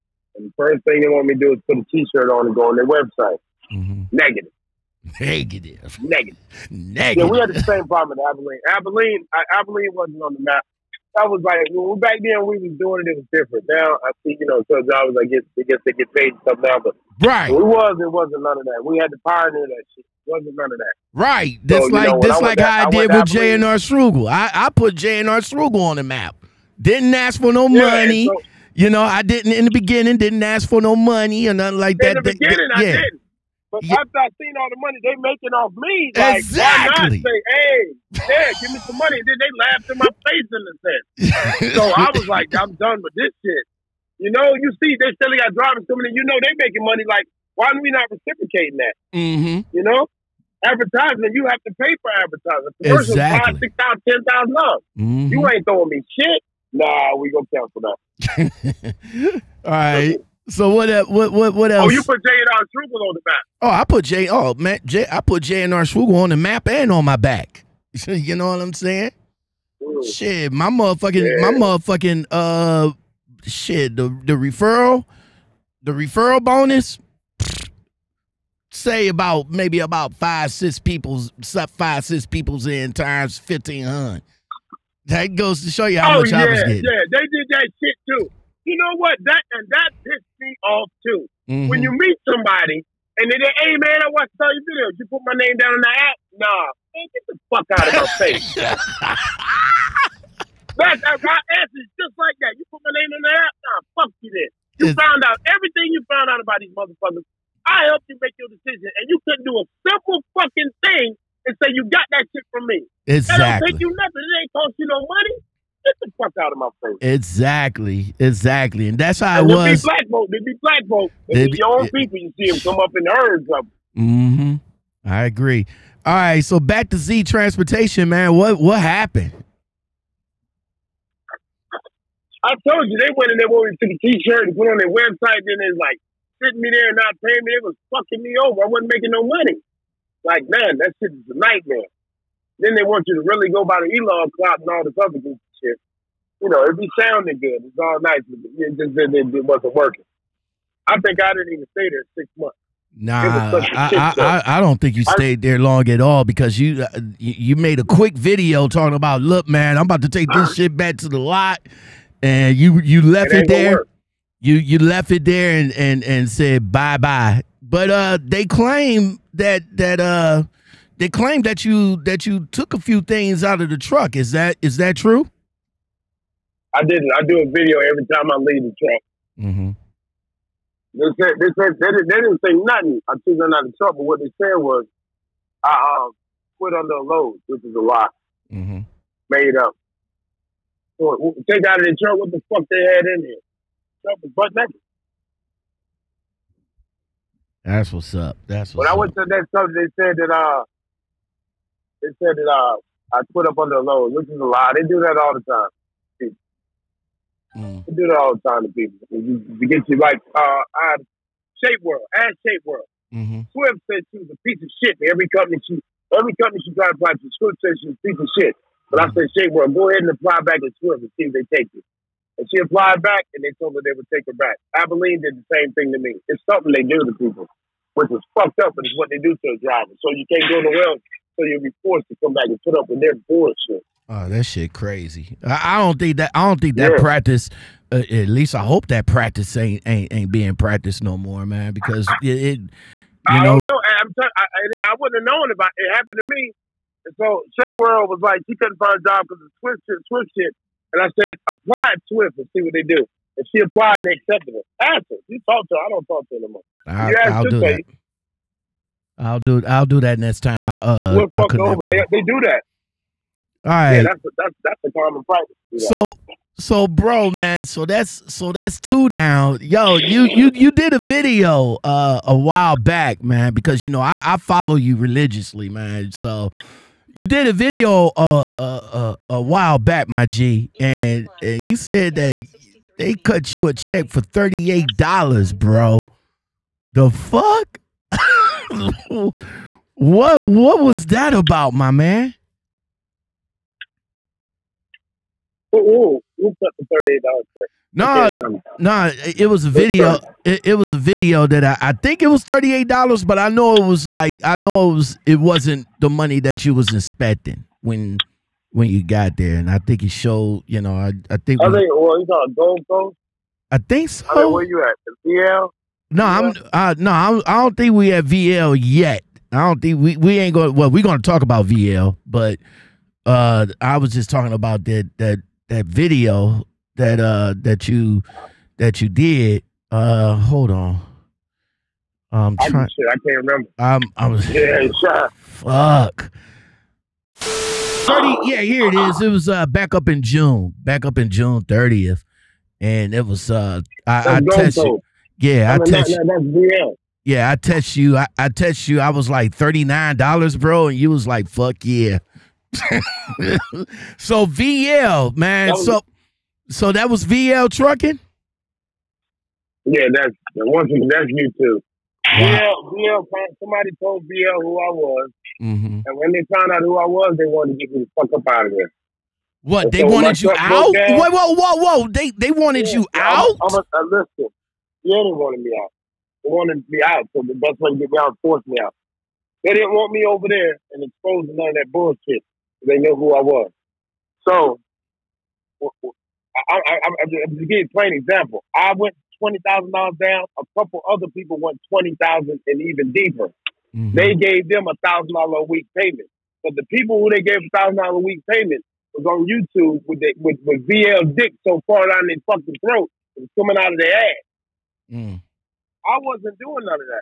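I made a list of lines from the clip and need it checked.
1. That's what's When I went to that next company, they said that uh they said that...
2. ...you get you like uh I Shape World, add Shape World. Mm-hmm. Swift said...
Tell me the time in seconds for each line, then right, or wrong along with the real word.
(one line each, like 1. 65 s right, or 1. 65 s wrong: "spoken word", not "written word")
1. 198 s right
2. 209 s right.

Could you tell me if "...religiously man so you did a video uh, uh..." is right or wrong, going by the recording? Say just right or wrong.
right.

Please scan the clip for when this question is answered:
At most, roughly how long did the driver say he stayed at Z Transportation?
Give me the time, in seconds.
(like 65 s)
152 s.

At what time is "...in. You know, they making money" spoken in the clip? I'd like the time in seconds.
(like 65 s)
46 s.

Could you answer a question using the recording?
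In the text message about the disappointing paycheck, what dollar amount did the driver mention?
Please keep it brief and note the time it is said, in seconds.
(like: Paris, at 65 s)
$39, at 349 s.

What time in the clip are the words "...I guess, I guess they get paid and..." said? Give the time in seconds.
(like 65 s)
15 s.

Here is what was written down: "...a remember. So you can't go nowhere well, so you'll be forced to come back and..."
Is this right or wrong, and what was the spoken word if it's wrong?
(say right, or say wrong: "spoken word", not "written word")
wrong: "driver", not "remember".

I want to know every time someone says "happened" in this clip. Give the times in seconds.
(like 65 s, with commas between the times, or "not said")
128 s, 245 s.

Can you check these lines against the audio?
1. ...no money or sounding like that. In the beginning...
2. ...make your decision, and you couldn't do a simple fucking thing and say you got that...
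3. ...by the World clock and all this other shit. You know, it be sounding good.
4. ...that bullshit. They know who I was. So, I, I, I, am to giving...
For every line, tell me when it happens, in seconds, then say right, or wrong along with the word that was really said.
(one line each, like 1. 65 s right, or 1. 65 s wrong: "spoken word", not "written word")
1. 30 s wrong: "nothing", not "sounding"
2. 108 s right
3. 143 s wrong: "Elon", not "World"
4. 381 s right.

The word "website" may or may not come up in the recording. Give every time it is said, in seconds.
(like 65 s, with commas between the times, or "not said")
2 s, 134 s.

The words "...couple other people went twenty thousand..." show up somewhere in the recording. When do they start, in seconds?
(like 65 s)
390 s.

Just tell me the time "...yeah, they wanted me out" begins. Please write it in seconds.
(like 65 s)
375 s.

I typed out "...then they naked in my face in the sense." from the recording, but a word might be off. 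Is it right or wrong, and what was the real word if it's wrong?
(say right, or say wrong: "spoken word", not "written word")
wrong: "laughed", not "naked".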